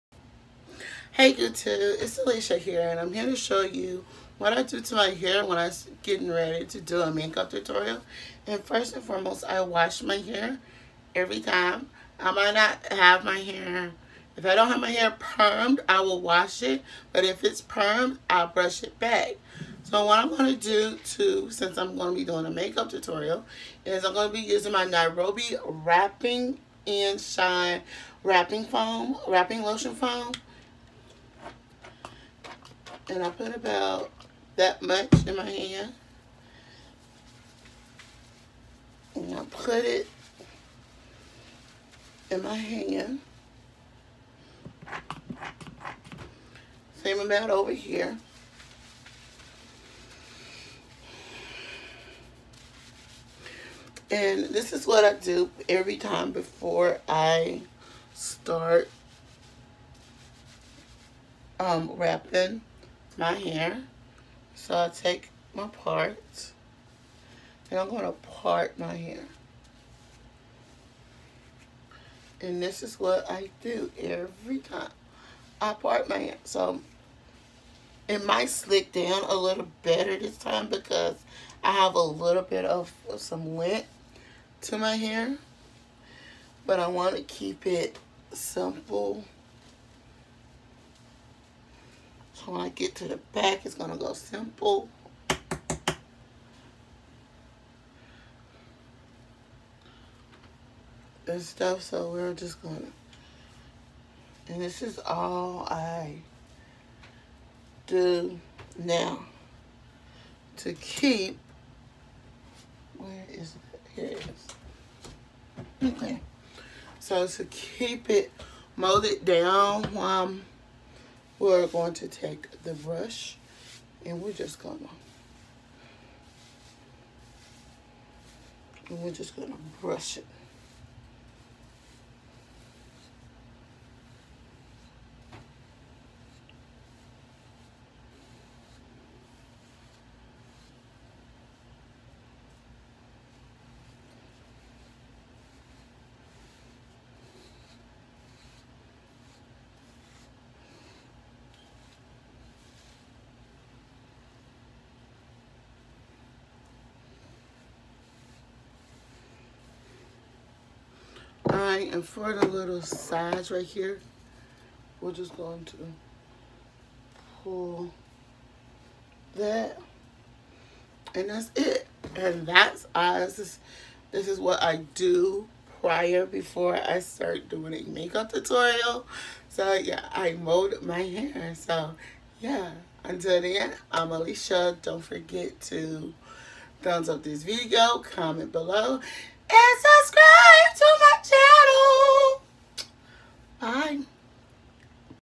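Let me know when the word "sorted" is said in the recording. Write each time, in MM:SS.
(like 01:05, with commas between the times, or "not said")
not said.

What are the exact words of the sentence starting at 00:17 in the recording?
But if it's permed, I'll brush it back.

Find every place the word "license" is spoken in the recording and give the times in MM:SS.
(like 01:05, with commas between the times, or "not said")
not said.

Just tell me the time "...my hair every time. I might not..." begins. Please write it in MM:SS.
00:10.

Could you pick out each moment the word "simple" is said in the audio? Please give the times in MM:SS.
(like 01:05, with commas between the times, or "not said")
01:28, 01:34.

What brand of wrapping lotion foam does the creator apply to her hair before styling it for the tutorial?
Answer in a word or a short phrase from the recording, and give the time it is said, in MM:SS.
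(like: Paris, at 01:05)
Nairobi, at 00:24.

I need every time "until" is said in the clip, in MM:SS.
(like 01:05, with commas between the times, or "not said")
03:03.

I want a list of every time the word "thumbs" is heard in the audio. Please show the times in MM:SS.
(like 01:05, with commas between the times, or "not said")
03:06.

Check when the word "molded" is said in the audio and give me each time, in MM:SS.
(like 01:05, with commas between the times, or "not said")
01:58, 03:00.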